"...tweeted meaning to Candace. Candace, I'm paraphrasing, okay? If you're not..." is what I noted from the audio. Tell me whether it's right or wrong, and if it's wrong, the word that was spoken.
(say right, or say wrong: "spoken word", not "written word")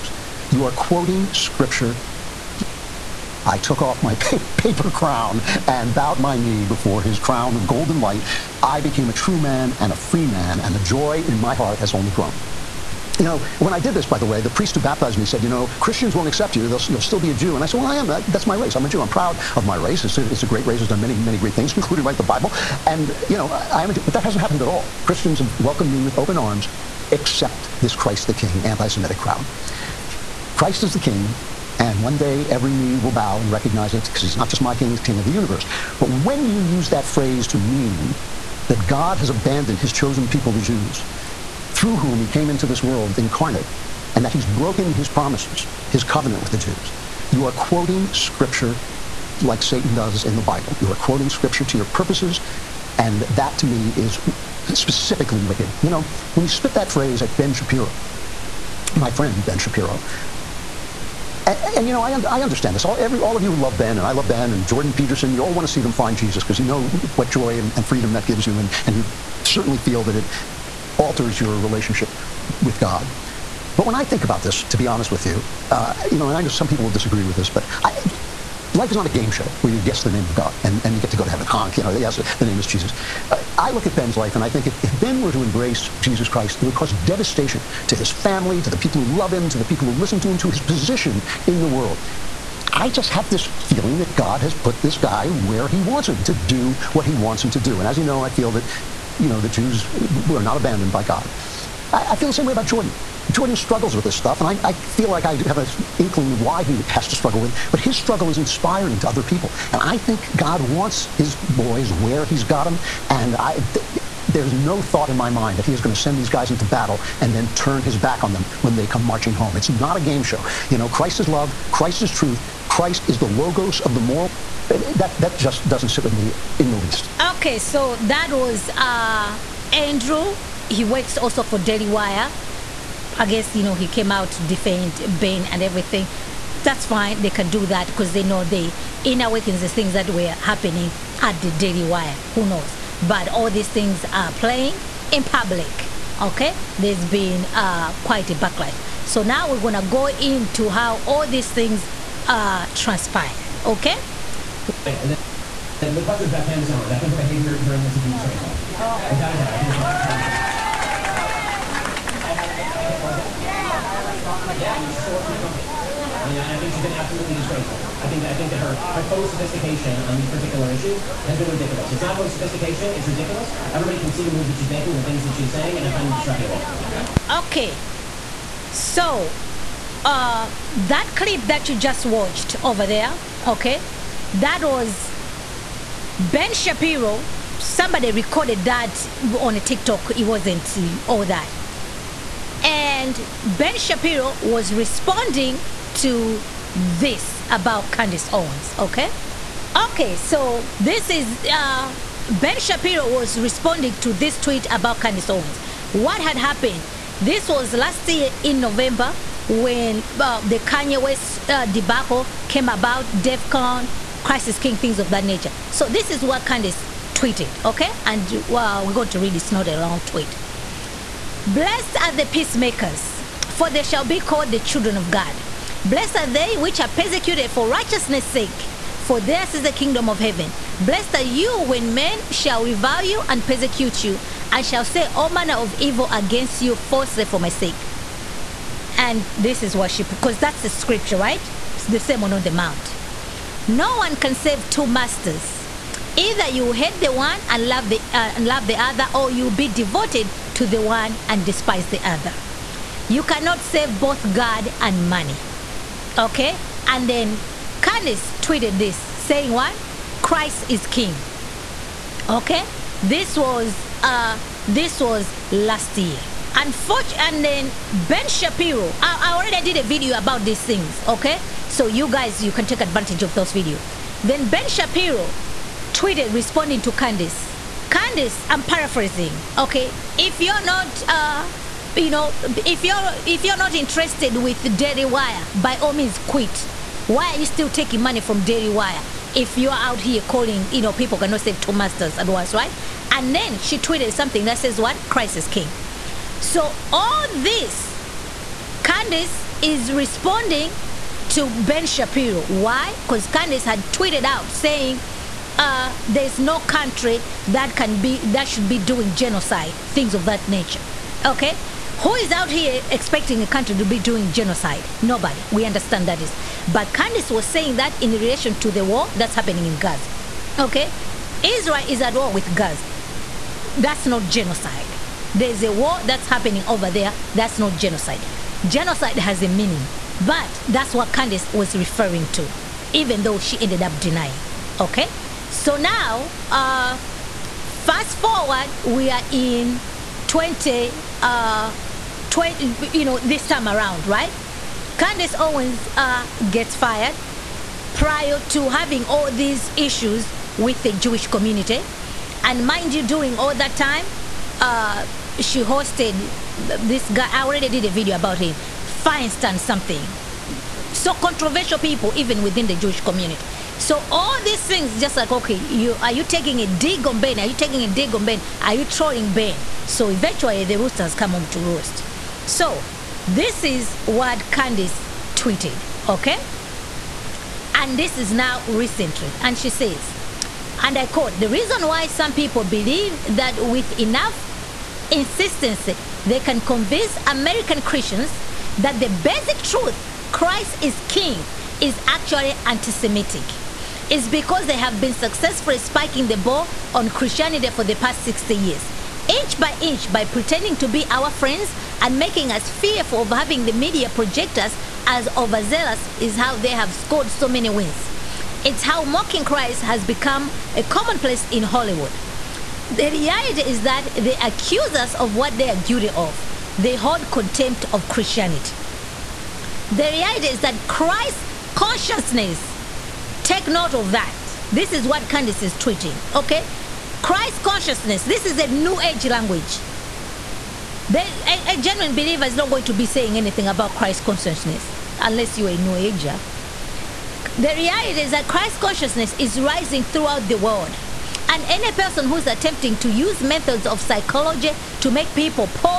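wrong: "responding", not "meaning".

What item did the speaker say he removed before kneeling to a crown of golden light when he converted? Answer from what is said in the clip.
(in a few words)
paper crown.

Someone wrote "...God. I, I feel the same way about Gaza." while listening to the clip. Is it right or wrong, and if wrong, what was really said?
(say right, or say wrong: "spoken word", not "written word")
wrong: "Jordan", not "Gaza".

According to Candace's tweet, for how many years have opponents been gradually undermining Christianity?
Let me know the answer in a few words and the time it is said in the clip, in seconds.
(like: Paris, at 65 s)
60 years, at 398 s.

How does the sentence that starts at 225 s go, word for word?
Blessed are they which are persecuted for righteousness' sake, for theirs is the kingdom of heaven.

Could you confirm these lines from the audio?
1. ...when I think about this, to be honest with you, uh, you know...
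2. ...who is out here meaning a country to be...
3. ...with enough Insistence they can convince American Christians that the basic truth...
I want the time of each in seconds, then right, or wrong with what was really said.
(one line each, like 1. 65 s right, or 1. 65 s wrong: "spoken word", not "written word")
1. 73 s right
2. 312 s wrong: "expecting", not "meaning"
3. 383 s right.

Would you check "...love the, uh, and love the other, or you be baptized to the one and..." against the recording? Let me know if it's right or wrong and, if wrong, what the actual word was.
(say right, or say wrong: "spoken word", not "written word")
wrong: "devoted", not "baptized".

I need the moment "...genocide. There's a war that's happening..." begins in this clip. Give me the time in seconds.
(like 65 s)
324 s.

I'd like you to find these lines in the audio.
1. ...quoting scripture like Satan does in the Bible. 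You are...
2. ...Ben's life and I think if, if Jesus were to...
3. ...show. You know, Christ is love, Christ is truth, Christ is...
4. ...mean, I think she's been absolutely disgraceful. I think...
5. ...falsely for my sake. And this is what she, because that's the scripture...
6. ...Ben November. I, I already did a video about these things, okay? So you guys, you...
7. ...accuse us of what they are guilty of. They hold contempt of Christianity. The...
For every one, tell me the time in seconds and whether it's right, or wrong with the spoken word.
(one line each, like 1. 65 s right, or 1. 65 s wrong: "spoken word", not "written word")
1. 47 s right
2. 83 s wrong: "Ben", not "Jesus"
3. 120 s right
4. 166 s right
5. 236 s right
6. 267 s wrong: "Shapiro", not "November"
7. 414 s right.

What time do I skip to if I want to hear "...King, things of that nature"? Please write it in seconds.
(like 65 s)
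214 s.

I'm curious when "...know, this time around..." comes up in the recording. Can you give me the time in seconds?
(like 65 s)
343 s.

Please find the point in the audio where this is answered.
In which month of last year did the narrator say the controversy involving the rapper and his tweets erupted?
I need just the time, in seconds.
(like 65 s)
208 s.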